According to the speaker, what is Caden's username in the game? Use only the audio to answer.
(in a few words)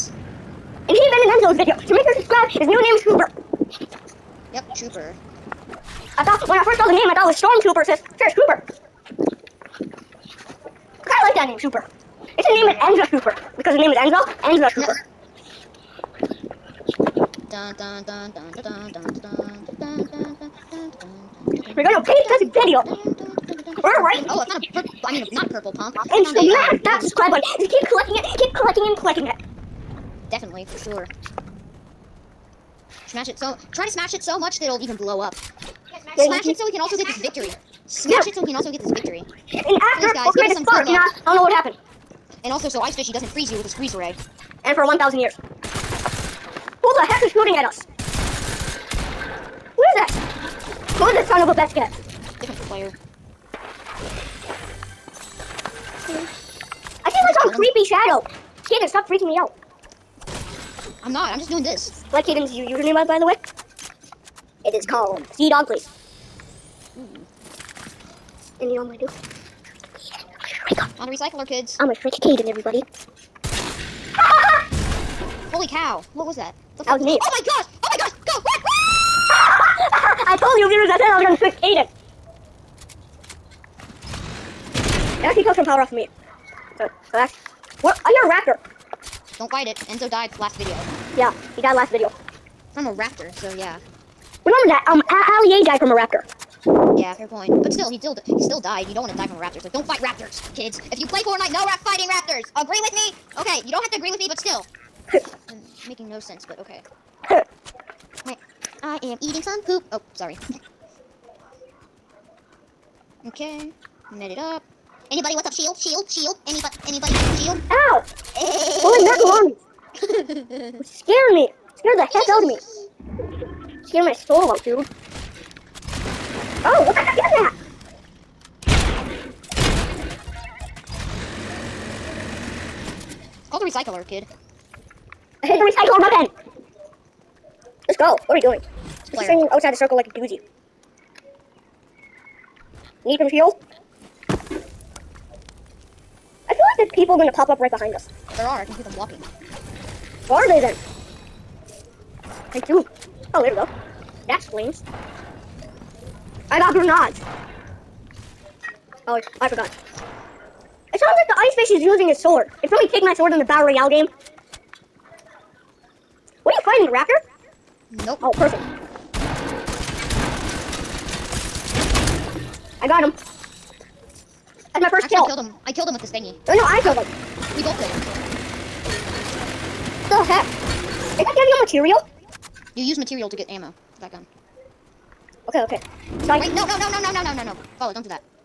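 Sea Dog Place.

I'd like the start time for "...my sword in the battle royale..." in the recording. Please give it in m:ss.
2:43.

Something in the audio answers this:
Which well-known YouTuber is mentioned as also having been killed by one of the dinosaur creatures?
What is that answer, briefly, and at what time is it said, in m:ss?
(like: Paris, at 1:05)
Ali A, at 1:35.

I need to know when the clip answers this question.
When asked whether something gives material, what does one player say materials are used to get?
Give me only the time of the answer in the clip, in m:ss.
3:03.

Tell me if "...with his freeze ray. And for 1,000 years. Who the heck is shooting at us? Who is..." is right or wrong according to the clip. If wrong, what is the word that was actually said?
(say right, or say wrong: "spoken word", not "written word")
right.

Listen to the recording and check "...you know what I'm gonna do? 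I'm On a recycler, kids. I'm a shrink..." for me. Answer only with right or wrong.
right.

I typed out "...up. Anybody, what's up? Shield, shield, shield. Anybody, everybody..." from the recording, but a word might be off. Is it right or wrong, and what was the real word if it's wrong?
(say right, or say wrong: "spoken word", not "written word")
wrong: "anybody", not "everybody".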